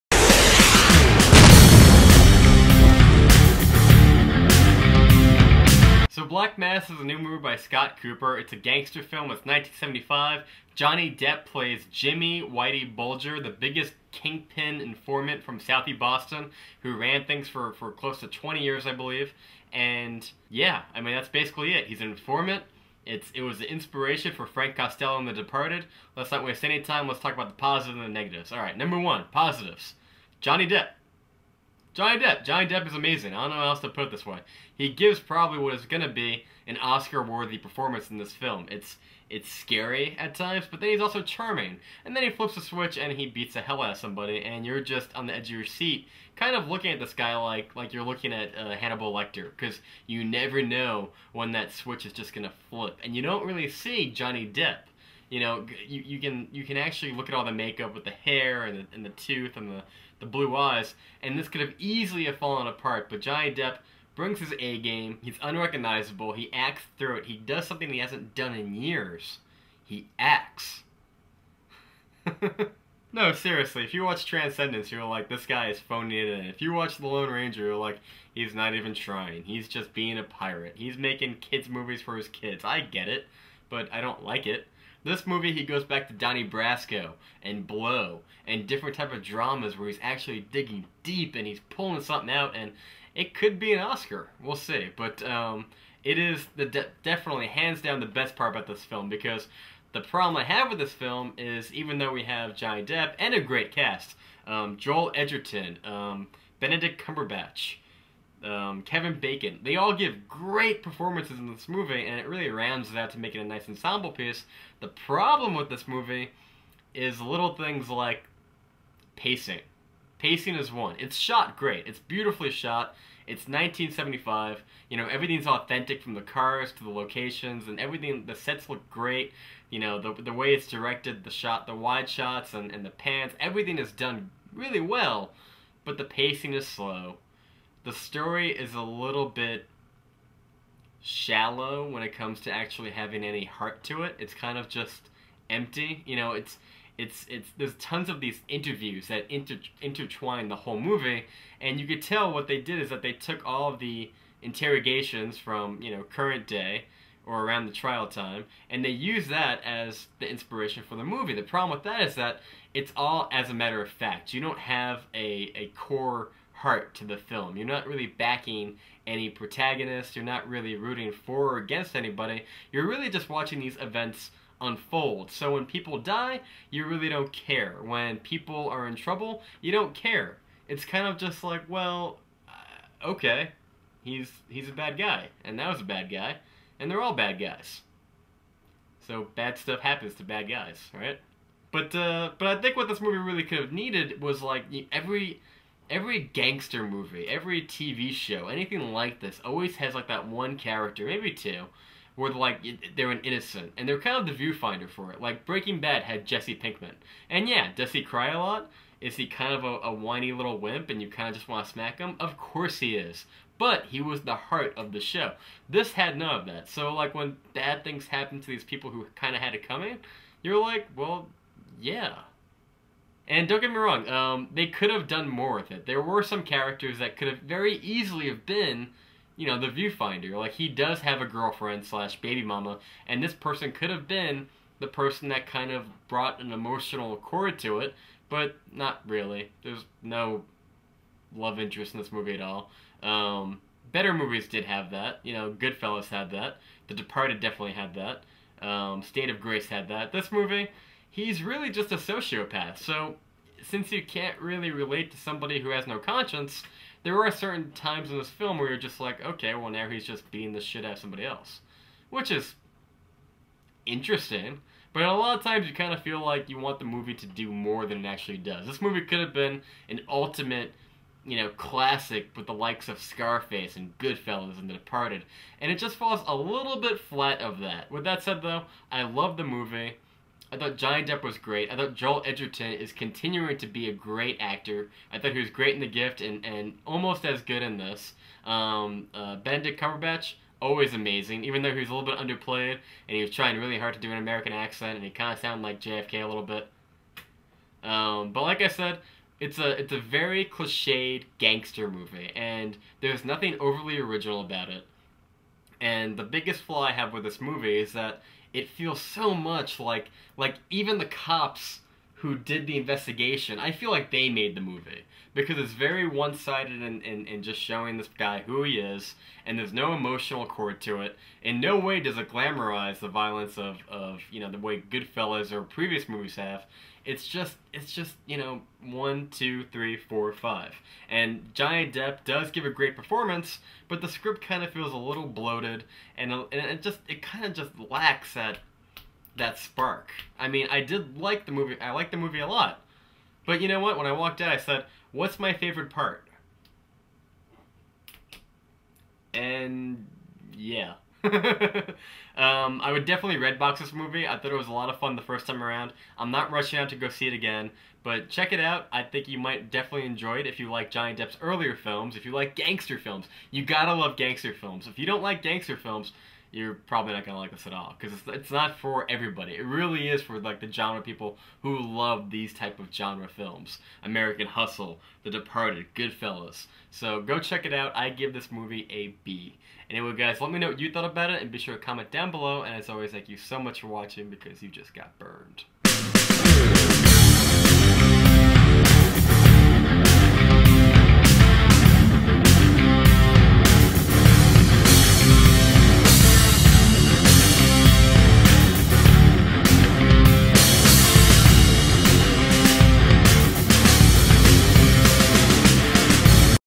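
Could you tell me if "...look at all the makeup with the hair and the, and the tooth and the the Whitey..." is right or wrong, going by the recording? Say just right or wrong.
wrong.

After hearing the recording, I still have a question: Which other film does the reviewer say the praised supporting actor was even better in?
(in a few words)
The Gift.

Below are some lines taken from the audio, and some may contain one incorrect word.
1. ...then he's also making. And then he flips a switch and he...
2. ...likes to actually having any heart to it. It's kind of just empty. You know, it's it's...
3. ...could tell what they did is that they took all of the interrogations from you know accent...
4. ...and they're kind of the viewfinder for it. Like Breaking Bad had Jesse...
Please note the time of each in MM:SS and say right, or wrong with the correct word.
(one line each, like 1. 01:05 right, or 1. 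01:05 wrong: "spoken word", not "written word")
1. 00:40 wrong: "charming", not "making"
2. 02:22 wrong: "comes", not "likes"
3. 02:31 wrong: "current", not "accent"
4. 03:23 right.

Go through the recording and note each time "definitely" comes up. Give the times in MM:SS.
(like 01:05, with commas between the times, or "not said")
01:37, 04:07, 05:53, 05:59.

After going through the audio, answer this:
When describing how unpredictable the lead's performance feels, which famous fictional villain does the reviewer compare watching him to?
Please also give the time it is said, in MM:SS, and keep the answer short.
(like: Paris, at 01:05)
Hannibal Lecter, at 00:48.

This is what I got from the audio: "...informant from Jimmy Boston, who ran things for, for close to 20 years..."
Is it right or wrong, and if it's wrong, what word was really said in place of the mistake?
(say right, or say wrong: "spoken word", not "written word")
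wrong: "Southie", not "Jimmy".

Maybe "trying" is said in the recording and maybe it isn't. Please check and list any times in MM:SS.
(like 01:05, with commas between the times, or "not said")
01:18, 04:53.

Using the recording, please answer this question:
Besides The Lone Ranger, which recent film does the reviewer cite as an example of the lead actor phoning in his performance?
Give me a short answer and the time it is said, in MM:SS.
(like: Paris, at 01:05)
Transcendence, at 01:14.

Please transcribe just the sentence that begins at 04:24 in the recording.
But a lot of times you kind of feel like you want the movie to do more than it actually does.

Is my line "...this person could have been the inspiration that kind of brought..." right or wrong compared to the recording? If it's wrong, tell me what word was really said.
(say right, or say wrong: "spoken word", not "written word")
wrong: "person", not "inspiration".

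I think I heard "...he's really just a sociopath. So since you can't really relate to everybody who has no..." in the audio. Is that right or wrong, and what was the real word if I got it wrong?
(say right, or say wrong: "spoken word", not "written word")
wrong: "somebody", not "everybody".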